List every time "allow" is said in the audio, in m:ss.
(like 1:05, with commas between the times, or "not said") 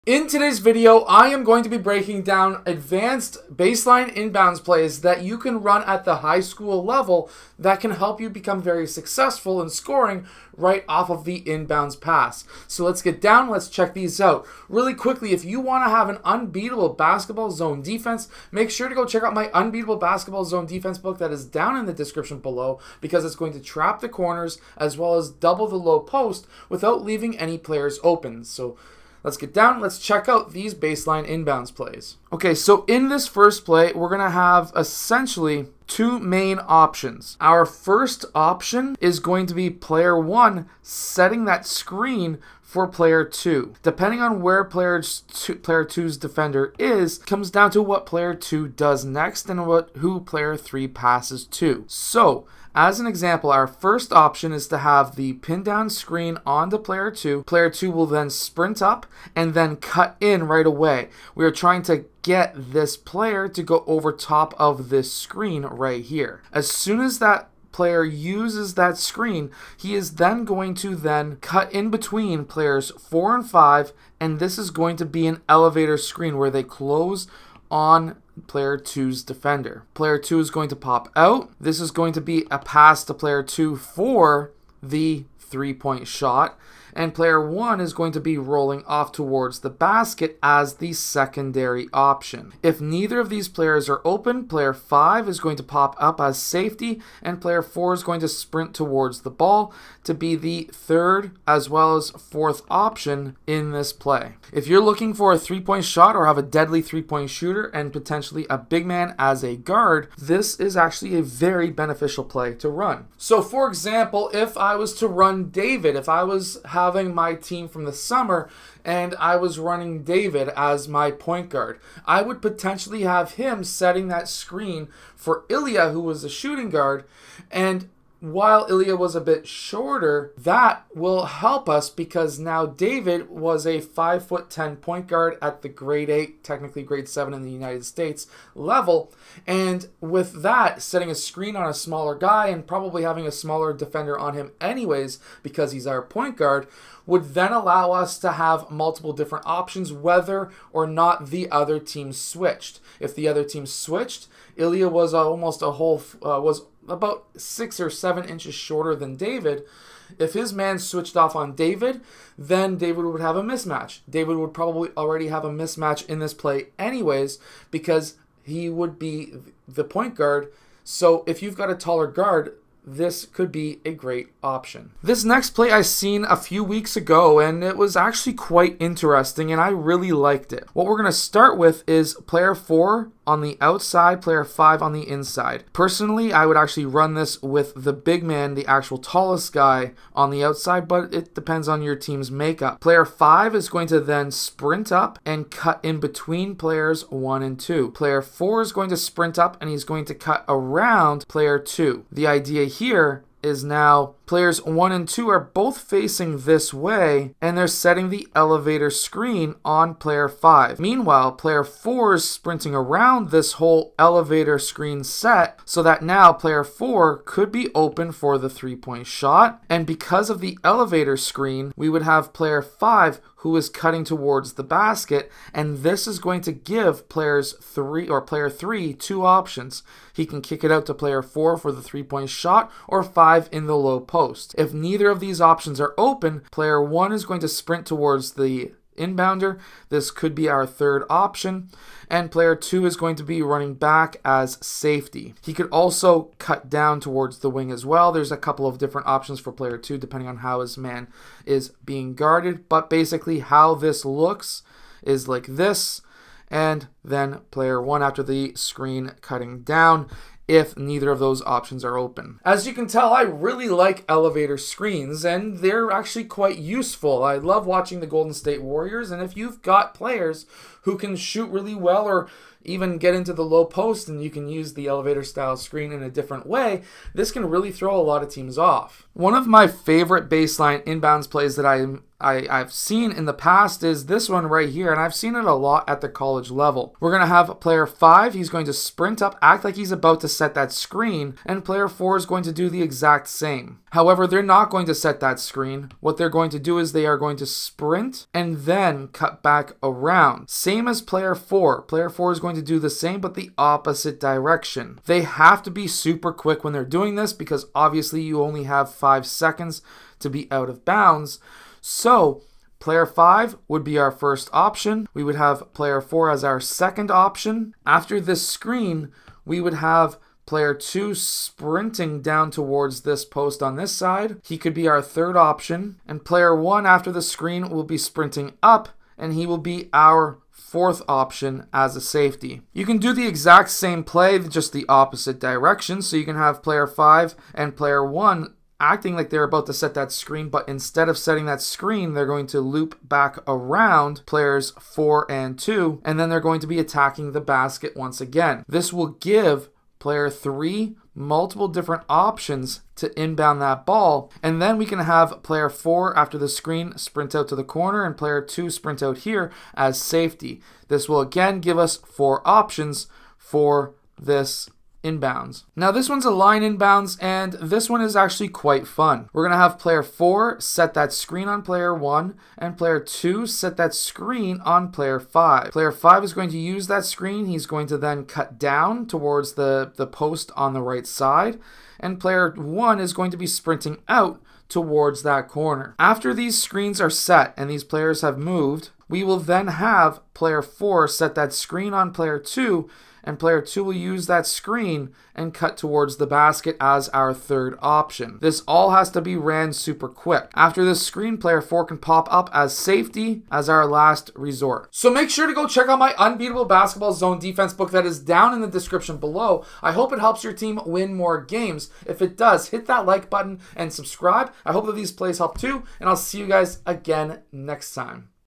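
2:27.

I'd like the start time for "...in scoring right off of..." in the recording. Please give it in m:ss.
0:09.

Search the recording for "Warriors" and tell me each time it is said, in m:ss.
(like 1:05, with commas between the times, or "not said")
4:28.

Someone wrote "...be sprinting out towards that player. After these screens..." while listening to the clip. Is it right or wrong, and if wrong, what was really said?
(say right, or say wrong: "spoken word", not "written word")
wrong: "corner", not "player".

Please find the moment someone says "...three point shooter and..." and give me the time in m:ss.
1:46.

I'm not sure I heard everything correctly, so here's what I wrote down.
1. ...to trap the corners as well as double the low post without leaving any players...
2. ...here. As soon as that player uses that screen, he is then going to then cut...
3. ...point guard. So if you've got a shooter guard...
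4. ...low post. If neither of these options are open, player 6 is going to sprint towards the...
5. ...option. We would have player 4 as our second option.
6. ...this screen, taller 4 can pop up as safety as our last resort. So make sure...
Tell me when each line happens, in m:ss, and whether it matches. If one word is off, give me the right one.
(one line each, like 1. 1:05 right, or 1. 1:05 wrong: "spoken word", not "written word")
1. 0:23 right
2. 1:06 right
3. 2:49 wrong: "taller", not "shooter"
4. 3:53 wrong: "1", not "6"
5. 5:14 right
6. 6:40 wrong: "player", not "taller".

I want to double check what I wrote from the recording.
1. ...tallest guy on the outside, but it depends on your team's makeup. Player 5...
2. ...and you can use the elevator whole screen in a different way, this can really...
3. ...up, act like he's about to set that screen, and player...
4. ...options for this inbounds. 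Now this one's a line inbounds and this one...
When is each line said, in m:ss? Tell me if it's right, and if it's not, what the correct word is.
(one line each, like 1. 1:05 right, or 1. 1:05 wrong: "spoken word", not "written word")
1. 3:08 right
2. 4:34 wrong: "style", not "whole"
3. 4:49 right
4. 6:02 right.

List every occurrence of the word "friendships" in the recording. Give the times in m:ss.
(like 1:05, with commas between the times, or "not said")
not said.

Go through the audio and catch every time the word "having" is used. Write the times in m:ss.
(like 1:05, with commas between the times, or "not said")
1:56, 2:23.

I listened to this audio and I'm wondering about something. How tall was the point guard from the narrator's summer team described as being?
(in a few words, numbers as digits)
5 foot 10.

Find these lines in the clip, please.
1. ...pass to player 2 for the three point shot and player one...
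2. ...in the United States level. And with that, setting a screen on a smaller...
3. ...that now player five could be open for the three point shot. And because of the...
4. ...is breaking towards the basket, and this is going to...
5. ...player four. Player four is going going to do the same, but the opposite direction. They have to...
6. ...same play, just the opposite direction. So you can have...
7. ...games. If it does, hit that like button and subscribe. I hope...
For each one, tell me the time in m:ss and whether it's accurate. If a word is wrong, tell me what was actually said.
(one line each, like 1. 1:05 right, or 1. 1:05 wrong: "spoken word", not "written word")
1. 1:22 right
2. 2:17 right
3. 3:35 wrong: "four", not "five"
4. 3:43 wrong: "cutting", not "breaking"
5. 5:01 right
6. 5:33 right
7. 6:51 right.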